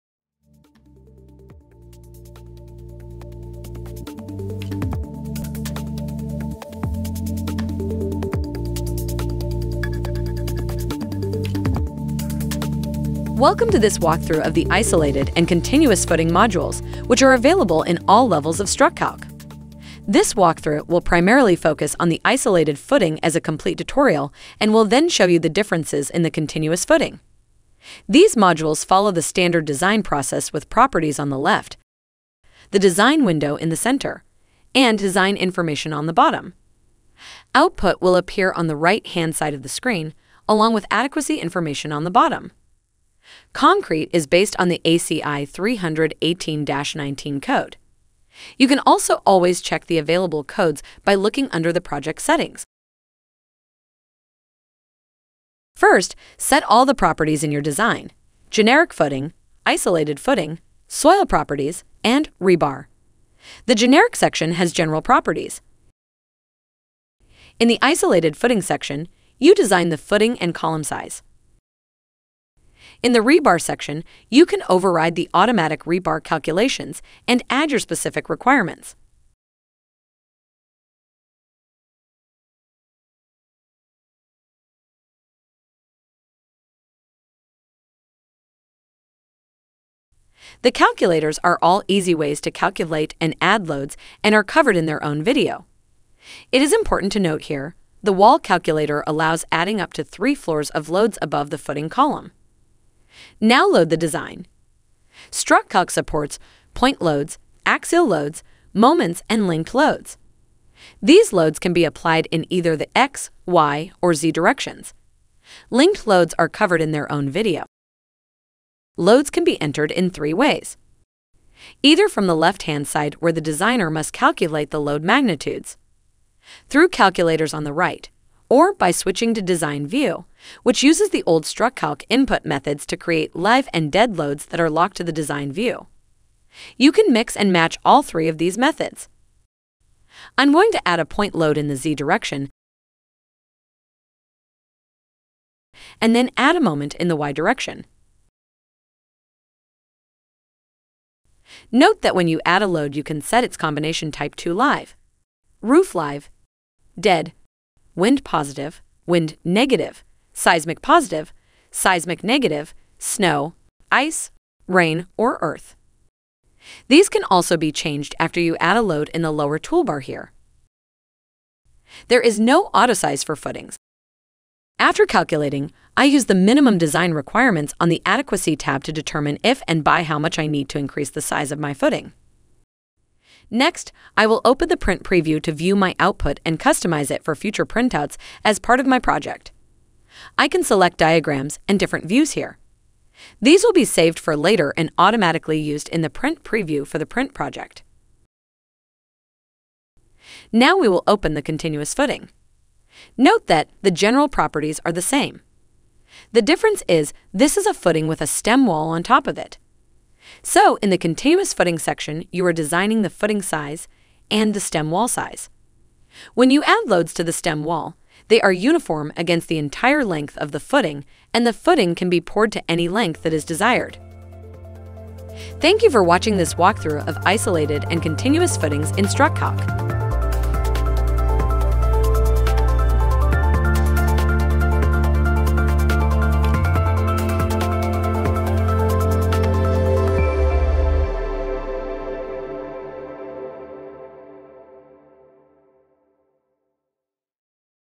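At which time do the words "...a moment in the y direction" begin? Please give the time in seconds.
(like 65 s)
146 s.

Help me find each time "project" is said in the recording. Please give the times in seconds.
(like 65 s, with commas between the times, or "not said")
51 s, 188 s, 197 s.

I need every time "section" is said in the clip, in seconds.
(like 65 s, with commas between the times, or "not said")
64 s, 68 s, 73 s, 211 s.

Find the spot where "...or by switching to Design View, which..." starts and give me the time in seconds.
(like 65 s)
128 s.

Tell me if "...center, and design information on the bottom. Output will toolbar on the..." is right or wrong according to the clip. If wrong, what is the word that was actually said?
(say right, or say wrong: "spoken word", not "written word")
wrong: "appear", not "toolbar".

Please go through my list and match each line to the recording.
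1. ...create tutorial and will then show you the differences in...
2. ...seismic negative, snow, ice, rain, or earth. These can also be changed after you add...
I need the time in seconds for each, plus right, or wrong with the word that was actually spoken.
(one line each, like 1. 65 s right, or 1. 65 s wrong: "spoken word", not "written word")
1. 23 s wrong: "complete", not "create"
2. 161 s right.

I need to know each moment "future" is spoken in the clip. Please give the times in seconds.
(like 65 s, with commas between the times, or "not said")
187 s.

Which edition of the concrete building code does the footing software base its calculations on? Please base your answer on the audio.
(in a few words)
ACI 318-19.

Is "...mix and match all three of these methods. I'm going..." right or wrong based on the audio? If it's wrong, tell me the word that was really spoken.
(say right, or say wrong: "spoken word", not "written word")
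right.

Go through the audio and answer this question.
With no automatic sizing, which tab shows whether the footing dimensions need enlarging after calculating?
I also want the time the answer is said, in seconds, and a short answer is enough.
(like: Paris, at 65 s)
Adequacy tab, at 178 s.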